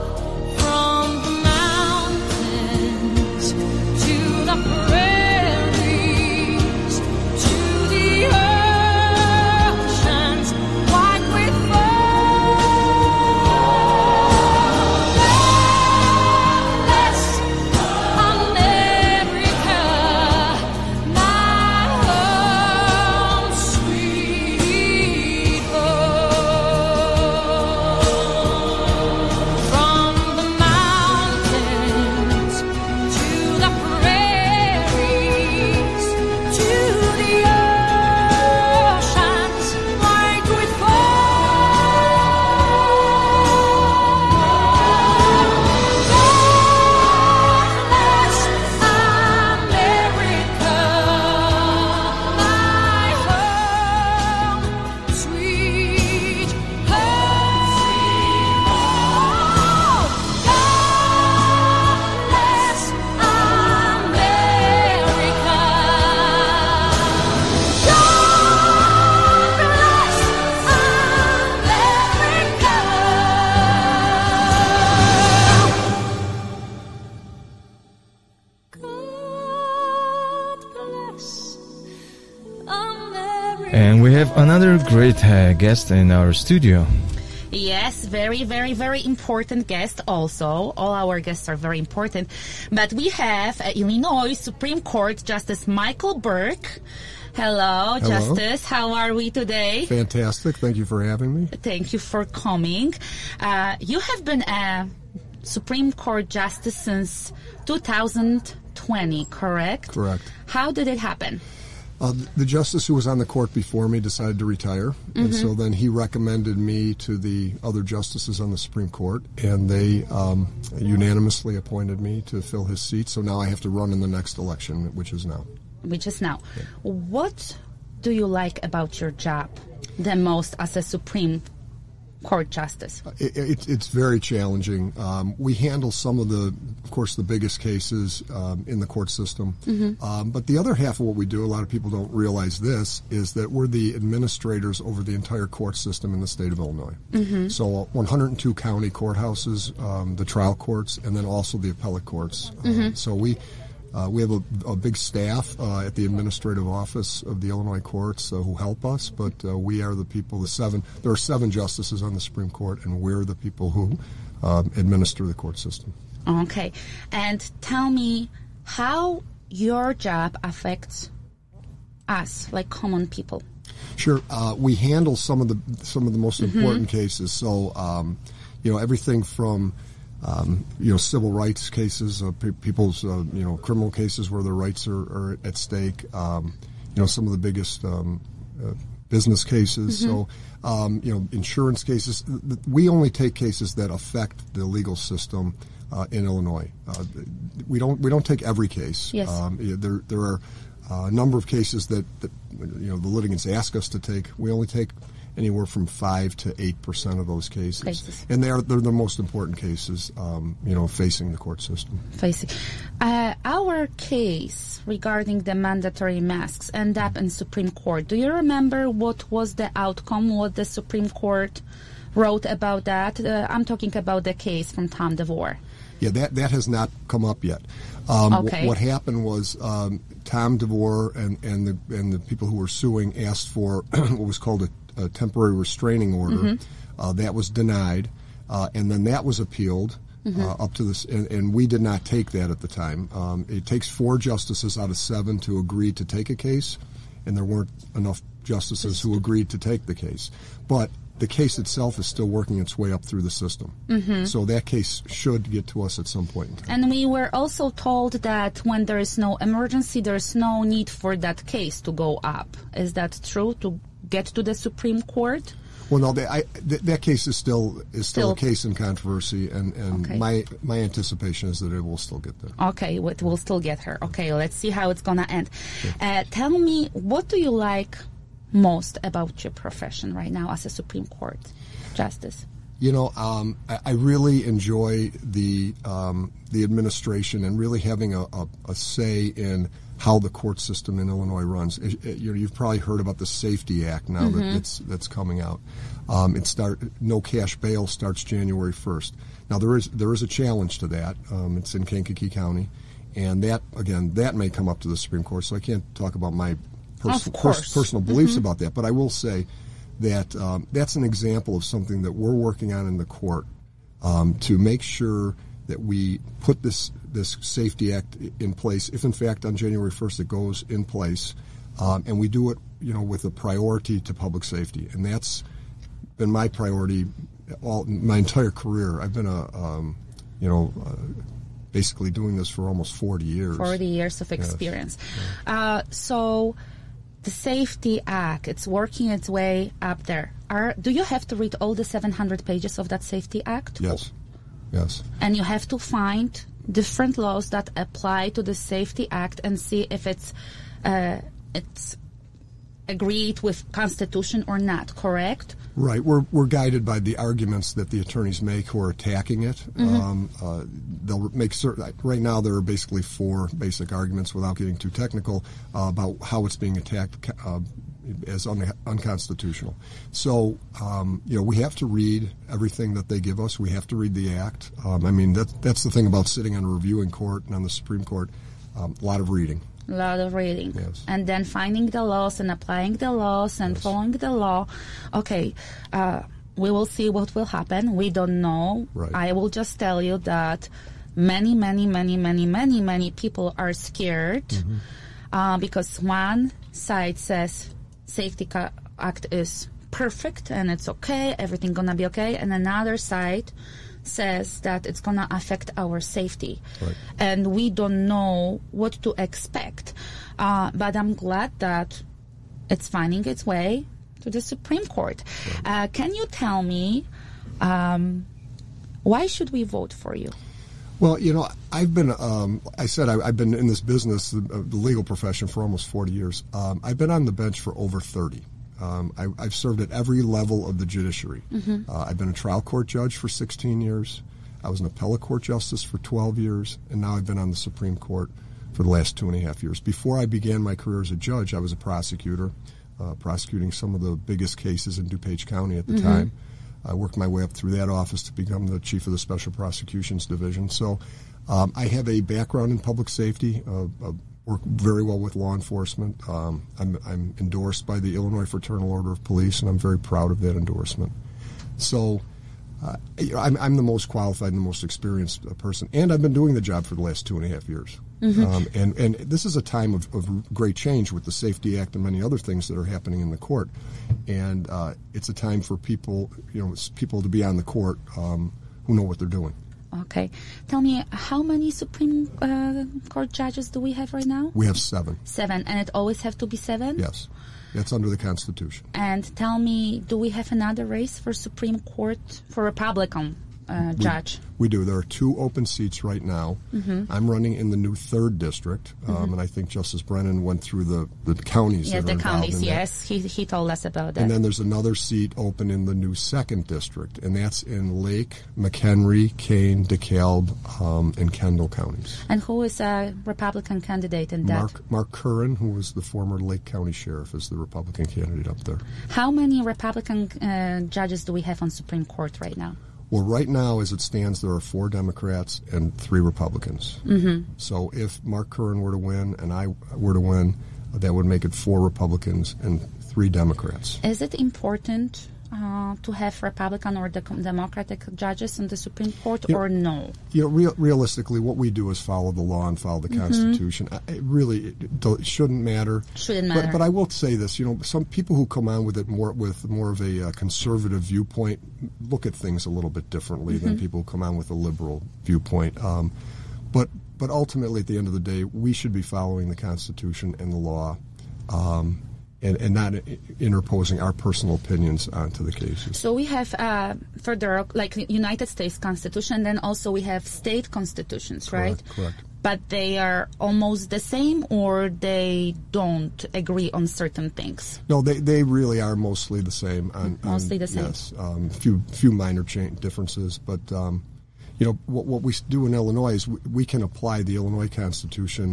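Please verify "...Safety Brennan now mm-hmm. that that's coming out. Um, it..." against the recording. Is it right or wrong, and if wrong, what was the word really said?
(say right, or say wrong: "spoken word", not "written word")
wrong: "Act", not "Brennan".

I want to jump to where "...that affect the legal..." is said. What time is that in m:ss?
3:13.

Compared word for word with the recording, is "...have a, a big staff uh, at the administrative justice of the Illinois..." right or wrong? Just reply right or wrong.
wrong.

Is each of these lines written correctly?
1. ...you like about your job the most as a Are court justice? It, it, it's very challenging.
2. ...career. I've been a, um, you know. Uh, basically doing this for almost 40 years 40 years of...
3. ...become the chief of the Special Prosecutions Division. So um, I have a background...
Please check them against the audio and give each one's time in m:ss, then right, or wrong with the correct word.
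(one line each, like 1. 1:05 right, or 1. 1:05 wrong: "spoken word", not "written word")
1. 2:08 wrong: "Supreme", not "Are"
2. 5:28 right
3. 7:28 right.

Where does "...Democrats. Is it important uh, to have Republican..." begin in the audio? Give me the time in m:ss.
8:53.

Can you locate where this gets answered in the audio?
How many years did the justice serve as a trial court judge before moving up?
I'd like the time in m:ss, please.
7:13.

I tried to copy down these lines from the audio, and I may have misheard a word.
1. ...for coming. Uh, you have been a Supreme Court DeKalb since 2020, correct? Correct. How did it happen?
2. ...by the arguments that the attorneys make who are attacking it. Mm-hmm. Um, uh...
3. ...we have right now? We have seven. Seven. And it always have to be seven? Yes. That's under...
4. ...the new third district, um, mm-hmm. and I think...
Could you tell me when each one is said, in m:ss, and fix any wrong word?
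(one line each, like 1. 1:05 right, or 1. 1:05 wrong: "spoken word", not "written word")
1. 1:41 wrong: "Justice", not "DeKalb"
2. 5:56 right
3. 8:03 right
4. 8:17 right.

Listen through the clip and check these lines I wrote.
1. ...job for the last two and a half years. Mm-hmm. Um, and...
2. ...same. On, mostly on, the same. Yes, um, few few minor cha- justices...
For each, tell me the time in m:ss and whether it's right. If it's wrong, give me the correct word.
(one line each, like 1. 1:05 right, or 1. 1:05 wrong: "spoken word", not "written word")
1. 7:46 right
2. 9:39 wrong: "differences", not "justices".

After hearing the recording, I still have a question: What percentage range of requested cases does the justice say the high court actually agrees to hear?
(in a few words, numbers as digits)
5 to 8 percent.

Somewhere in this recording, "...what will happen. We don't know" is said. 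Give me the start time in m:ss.
6:27.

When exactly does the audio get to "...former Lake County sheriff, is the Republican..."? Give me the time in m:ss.
8:36.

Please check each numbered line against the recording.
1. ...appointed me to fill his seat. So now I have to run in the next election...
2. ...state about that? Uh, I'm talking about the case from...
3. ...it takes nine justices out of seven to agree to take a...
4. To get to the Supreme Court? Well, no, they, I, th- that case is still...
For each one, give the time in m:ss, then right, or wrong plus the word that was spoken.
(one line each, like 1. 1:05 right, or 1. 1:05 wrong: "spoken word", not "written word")
1. 2:01 right
2. 3:42 wrong: "wrote", not "state"
3. 4:03 wrong: "four", not "nine"
4. 4:23 right.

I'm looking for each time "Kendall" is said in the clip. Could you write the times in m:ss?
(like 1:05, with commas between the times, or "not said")
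8:31.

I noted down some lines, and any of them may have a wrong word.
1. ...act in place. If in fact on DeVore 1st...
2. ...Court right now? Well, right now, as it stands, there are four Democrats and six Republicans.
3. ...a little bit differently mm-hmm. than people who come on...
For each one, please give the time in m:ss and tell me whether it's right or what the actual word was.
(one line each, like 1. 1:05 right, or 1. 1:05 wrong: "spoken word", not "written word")
1. 5:17 wrong: "January", not "DeVore"
2. 8:42 wrong: "three", not "six"
3. 9:12 right.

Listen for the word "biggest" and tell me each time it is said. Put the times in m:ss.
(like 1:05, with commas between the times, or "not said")
2:17, 3:07, 7:24.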